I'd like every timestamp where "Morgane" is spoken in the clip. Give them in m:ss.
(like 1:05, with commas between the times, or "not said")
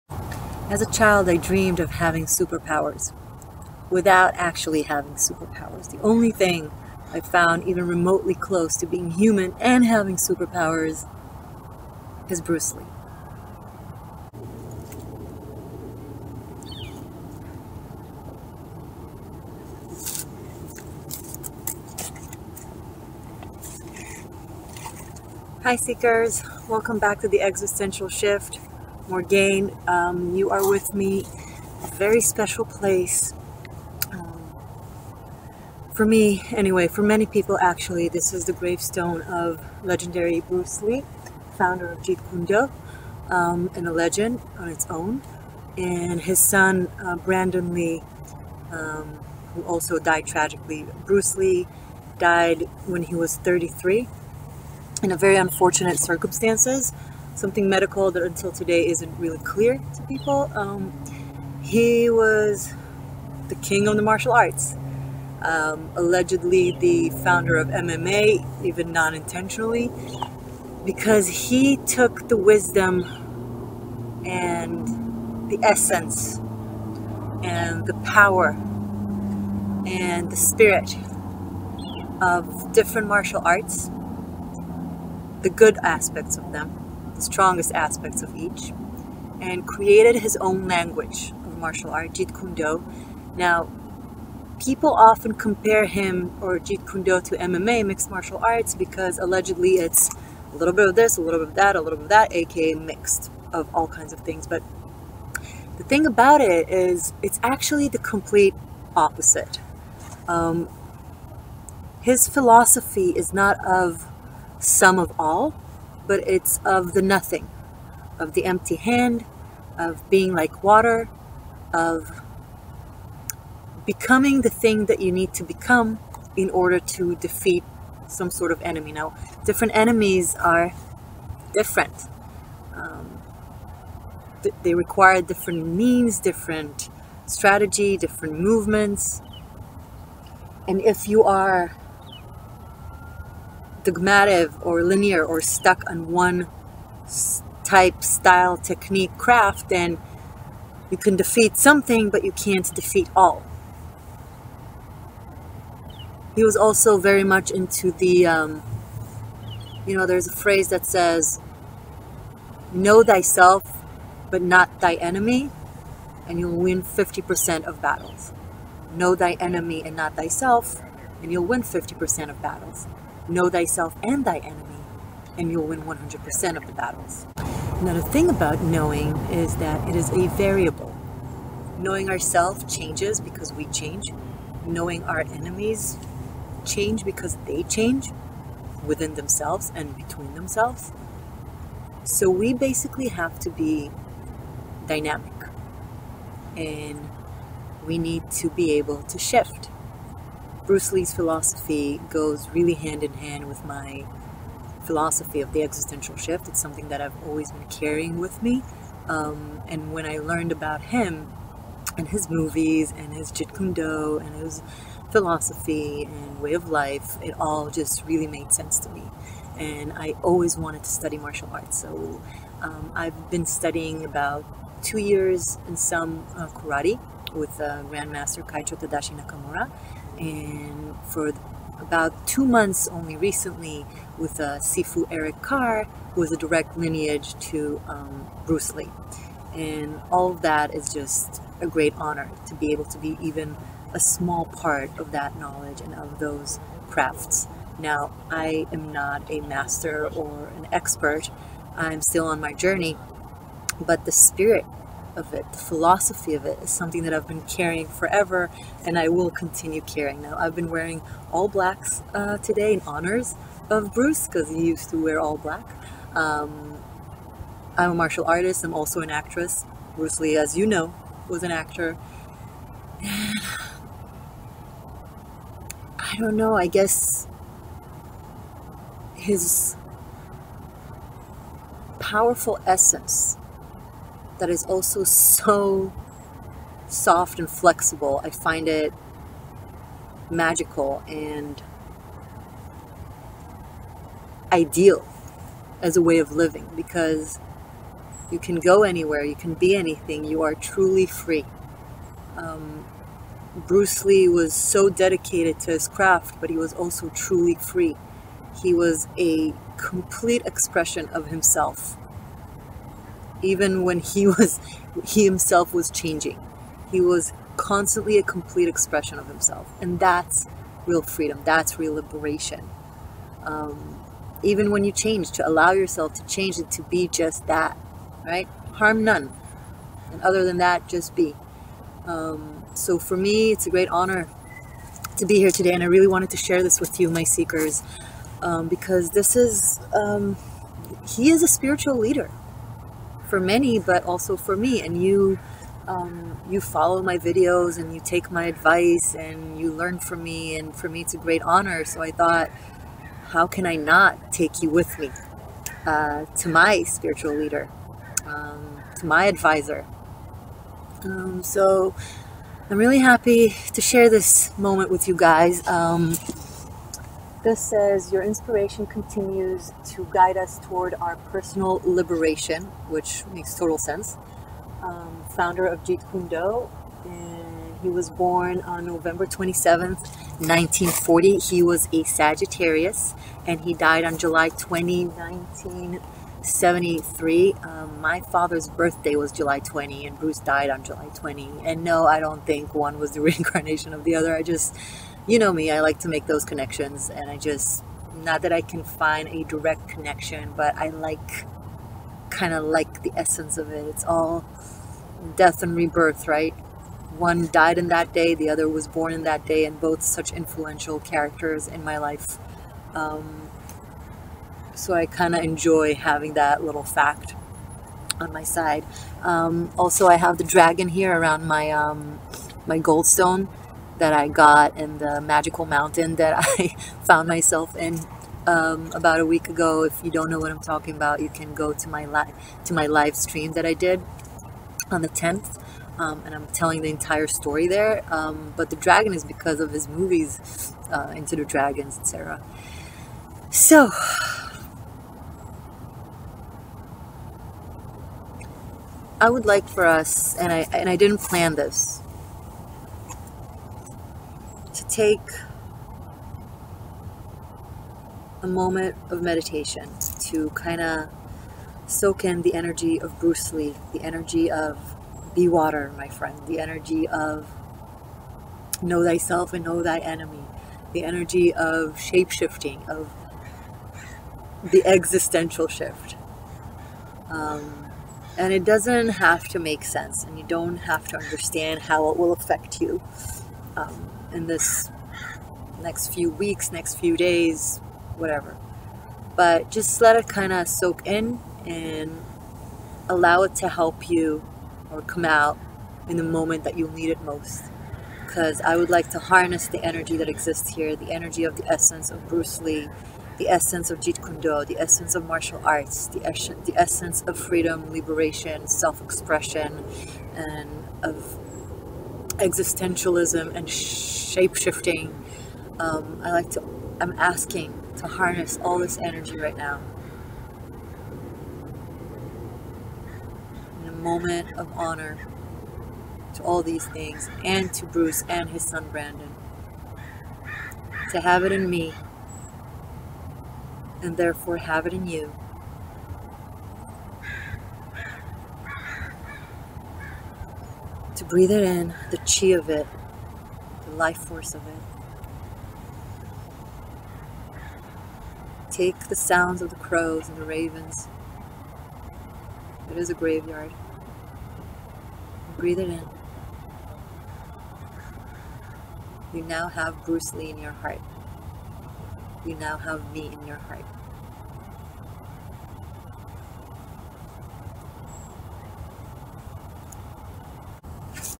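0:29.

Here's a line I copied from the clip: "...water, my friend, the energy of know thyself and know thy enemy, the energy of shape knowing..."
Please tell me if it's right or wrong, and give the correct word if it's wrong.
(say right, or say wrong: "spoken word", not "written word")
wrong: "shifting", not "knowing".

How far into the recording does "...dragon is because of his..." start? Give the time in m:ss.
7:18.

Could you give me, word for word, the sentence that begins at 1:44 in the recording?
But the thing about it is, it's actually the complete opposite.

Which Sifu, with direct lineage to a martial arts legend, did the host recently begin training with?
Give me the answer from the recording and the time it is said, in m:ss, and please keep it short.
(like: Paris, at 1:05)
Sifu Eric Carr, at 3:54.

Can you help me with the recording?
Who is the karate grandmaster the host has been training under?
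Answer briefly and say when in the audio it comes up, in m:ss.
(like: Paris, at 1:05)
Kaicho Tadashi Nakamura, at 3:48.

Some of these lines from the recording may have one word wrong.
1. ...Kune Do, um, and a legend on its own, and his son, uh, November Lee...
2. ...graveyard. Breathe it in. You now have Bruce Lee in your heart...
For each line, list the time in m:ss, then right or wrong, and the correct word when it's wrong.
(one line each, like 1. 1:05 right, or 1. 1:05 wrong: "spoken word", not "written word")
1. 0:42 wrong: "Brandon", not "November"
2. 9:13 right.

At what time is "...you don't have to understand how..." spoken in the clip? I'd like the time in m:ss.
8:00.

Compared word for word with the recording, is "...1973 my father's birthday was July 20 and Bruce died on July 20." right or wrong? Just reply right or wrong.
right.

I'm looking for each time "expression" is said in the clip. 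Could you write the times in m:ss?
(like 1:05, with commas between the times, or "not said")
5:10, 5:18, 8:29.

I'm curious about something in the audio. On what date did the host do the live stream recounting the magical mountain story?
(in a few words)
The 10th.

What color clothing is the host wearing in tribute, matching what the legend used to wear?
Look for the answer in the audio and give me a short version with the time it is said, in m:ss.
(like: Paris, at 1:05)
Black, at 4:21.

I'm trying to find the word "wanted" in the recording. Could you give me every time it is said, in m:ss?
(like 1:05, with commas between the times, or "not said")
3:40, 5:36.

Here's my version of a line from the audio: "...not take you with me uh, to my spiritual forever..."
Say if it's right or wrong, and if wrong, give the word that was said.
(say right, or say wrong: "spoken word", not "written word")
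wrong: "leader", not "forever".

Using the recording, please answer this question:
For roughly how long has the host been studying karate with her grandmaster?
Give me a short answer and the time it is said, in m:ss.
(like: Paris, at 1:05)
About two years, at 3:44.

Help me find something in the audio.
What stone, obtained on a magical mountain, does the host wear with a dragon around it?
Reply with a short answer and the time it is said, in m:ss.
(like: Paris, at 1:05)
Goldstone, at 7:02.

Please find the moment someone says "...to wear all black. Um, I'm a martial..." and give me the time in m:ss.
4:24.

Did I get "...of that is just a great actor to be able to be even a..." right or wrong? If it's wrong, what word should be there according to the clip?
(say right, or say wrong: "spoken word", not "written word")
wrong: "honor", not "actor".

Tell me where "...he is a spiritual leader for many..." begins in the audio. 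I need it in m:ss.
5:41.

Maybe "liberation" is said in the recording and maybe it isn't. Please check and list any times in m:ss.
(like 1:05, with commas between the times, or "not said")
5:21, 6:11, 8:27.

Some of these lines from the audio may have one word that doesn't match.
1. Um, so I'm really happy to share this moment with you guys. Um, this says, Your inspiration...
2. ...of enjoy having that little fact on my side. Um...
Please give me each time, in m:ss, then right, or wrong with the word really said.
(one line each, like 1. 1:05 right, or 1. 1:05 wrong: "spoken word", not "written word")
1. 6:01 right
2. 6:55 right.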